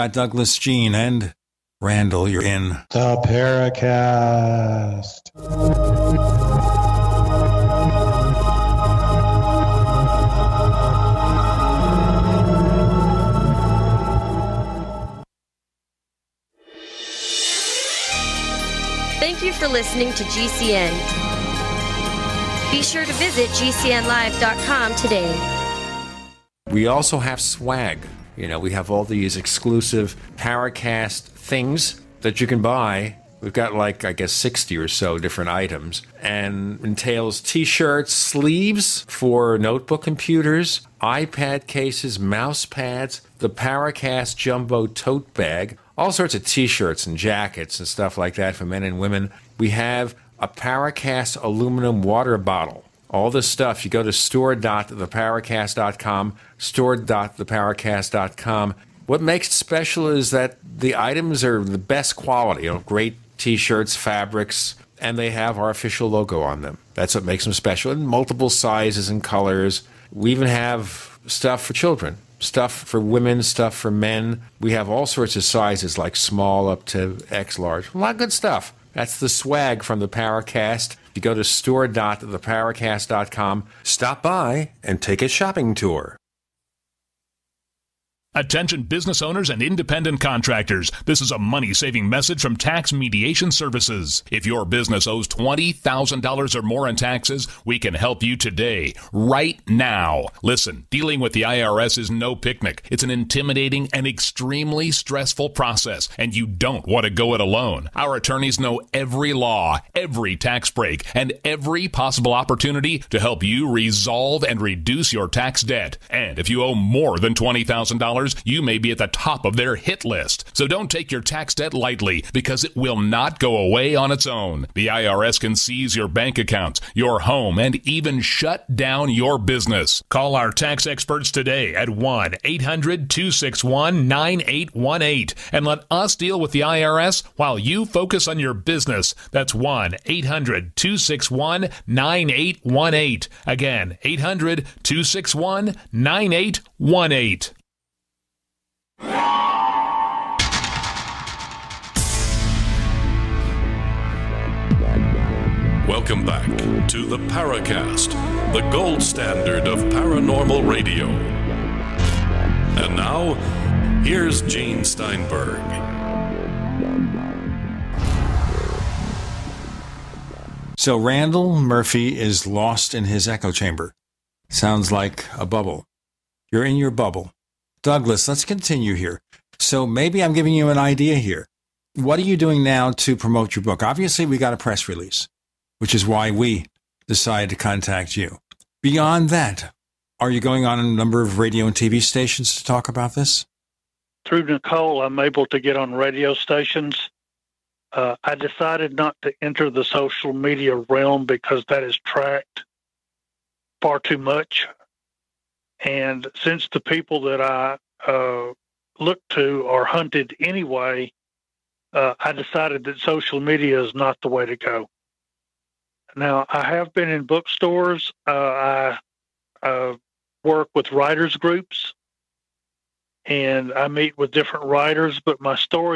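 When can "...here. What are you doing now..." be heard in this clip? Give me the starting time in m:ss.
3:01.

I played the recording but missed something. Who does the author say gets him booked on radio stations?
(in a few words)
Nicole.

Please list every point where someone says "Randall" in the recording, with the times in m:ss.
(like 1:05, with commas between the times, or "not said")
0:01, 2:50.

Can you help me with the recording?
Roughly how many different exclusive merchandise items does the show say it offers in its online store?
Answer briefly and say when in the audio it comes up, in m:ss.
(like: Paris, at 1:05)
60, at 0:34.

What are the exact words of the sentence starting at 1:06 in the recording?
That's what makes them special in multiple sizes and colors.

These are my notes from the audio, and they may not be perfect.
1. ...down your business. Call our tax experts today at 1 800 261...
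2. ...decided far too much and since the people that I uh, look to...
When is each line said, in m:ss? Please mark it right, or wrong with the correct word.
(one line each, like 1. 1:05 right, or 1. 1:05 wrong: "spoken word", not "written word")
1. 2:08 right
2. 3:22 wrong: "tracked", not "decided".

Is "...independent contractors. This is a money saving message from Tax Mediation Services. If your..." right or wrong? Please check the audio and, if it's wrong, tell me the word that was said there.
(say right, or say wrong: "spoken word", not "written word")
right.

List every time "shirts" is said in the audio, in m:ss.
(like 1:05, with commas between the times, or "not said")
0:37, 0:46, 1:03.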